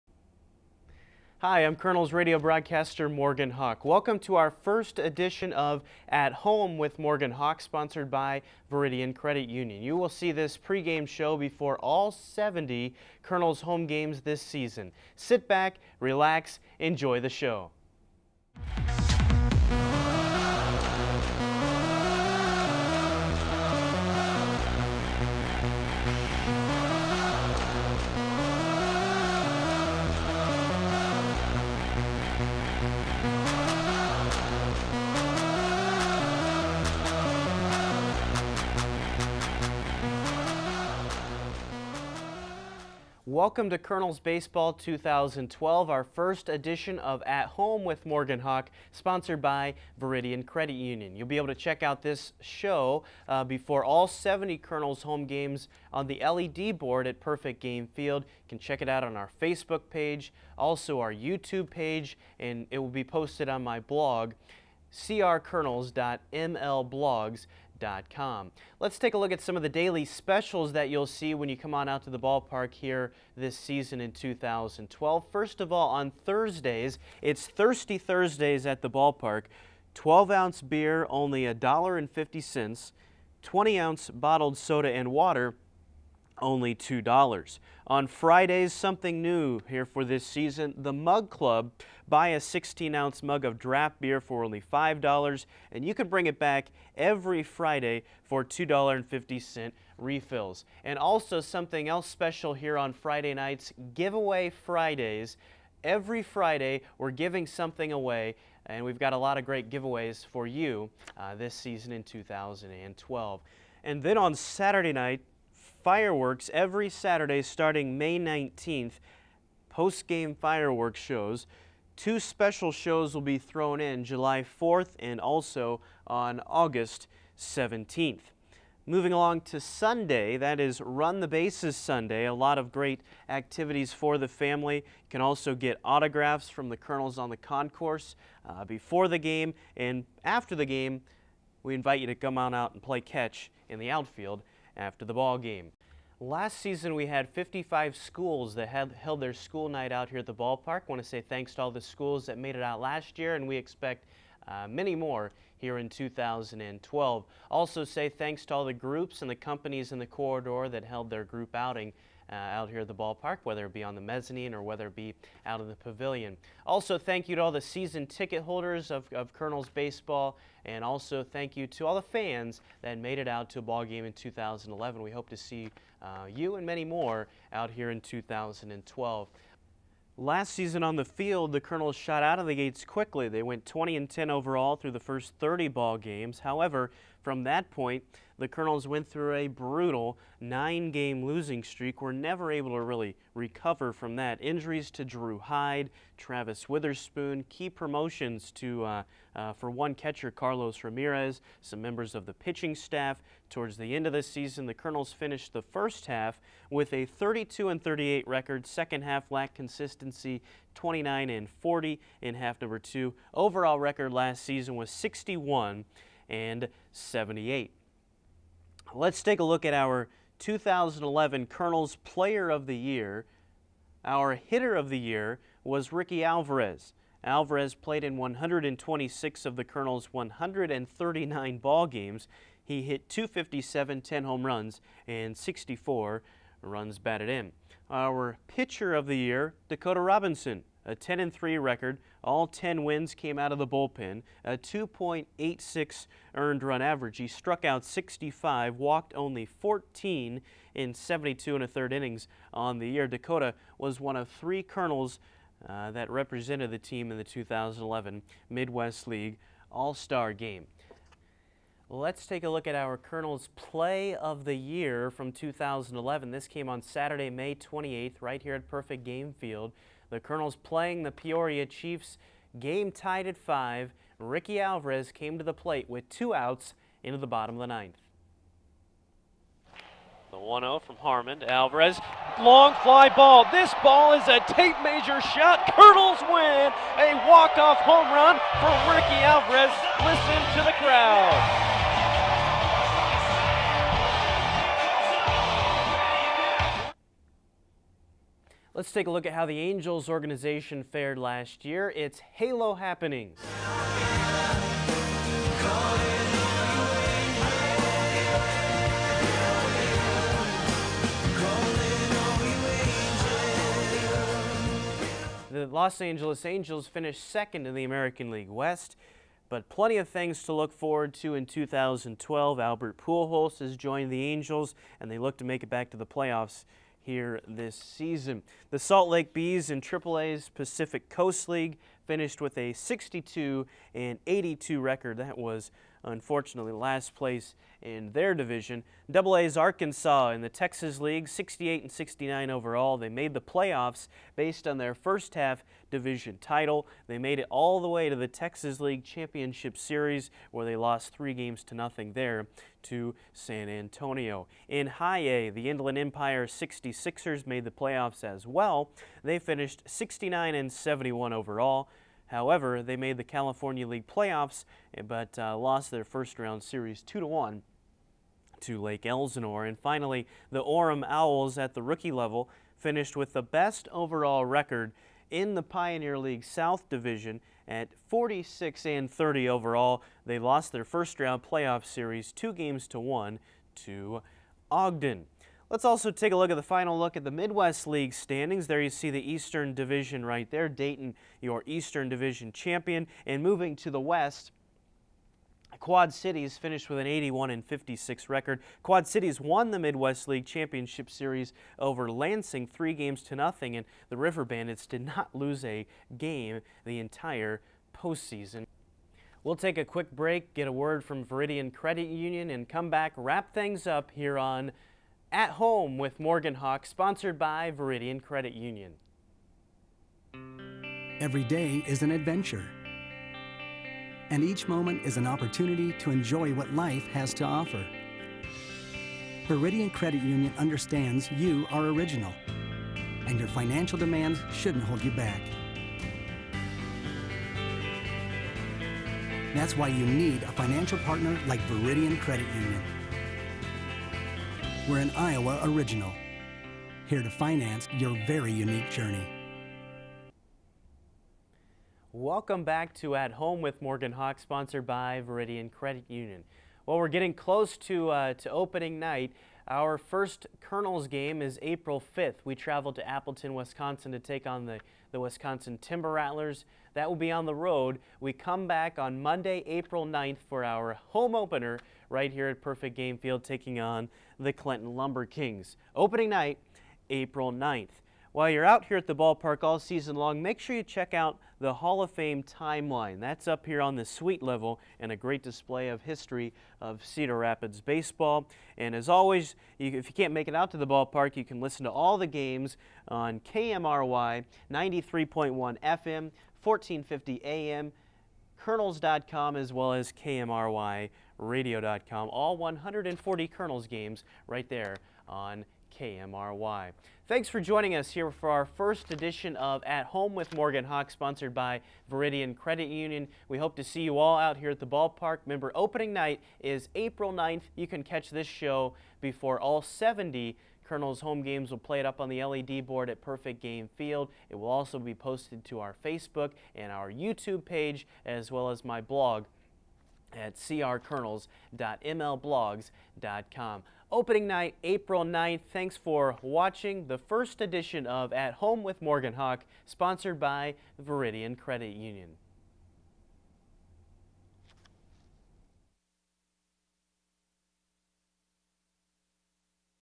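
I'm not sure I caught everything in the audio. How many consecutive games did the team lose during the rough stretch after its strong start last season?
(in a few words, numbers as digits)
9.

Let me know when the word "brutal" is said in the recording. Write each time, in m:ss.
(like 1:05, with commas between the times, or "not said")
3:09.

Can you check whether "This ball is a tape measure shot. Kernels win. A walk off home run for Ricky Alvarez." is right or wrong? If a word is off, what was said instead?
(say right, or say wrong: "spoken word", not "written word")
right.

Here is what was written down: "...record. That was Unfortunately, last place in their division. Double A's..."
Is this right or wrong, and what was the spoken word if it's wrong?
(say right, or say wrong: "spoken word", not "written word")
right.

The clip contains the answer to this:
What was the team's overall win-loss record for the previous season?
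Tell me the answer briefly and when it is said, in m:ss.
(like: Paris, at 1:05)
61 and 78, at 3:34.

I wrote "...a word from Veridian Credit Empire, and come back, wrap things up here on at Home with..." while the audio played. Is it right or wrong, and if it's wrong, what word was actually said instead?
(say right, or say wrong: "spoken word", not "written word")
wrong: "Union", not "Empire".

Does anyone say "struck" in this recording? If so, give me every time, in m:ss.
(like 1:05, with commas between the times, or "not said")
4:07.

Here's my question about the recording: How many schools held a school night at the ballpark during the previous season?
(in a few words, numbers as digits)
55.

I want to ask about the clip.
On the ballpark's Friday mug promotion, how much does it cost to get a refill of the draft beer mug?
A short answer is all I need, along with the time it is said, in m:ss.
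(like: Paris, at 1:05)
$2.50, at 1:38.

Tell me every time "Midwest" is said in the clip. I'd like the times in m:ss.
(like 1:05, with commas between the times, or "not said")
4:18, 6:27, 6:39.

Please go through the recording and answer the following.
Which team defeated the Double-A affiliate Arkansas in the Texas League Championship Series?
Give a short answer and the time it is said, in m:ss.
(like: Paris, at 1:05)
San Antonio, at 5:53.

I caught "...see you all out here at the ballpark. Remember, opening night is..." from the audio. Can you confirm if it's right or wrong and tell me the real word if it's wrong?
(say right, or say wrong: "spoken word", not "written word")
right.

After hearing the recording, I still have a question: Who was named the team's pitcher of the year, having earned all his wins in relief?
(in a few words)
Dakota Robinson.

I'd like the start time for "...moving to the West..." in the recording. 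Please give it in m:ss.
6:33.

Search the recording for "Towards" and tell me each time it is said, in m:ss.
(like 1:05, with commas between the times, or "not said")
3:23.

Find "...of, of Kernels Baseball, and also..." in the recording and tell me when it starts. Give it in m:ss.
2:48.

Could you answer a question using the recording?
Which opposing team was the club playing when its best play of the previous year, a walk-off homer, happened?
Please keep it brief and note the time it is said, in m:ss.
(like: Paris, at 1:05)
Peoria Chiefs, at 4:31.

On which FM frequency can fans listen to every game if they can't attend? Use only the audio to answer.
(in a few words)
93.1 FM.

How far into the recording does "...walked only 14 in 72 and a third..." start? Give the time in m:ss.
4:08.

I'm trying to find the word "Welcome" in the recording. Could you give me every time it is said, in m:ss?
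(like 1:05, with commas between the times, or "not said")
0:03, 0:43, 7:32.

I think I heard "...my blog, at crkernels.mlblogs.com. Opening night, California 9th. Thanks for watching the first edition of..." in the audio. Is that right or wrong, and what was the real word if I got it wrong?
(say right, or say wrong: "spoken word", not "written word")
wrong: "April", not "California".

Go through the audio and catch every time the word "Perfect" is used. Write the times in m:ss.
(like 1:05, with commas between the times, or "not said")
0:57, 4:28, 7:52, 8:43.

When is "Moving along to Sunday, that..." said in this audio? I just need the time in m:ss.
2:08.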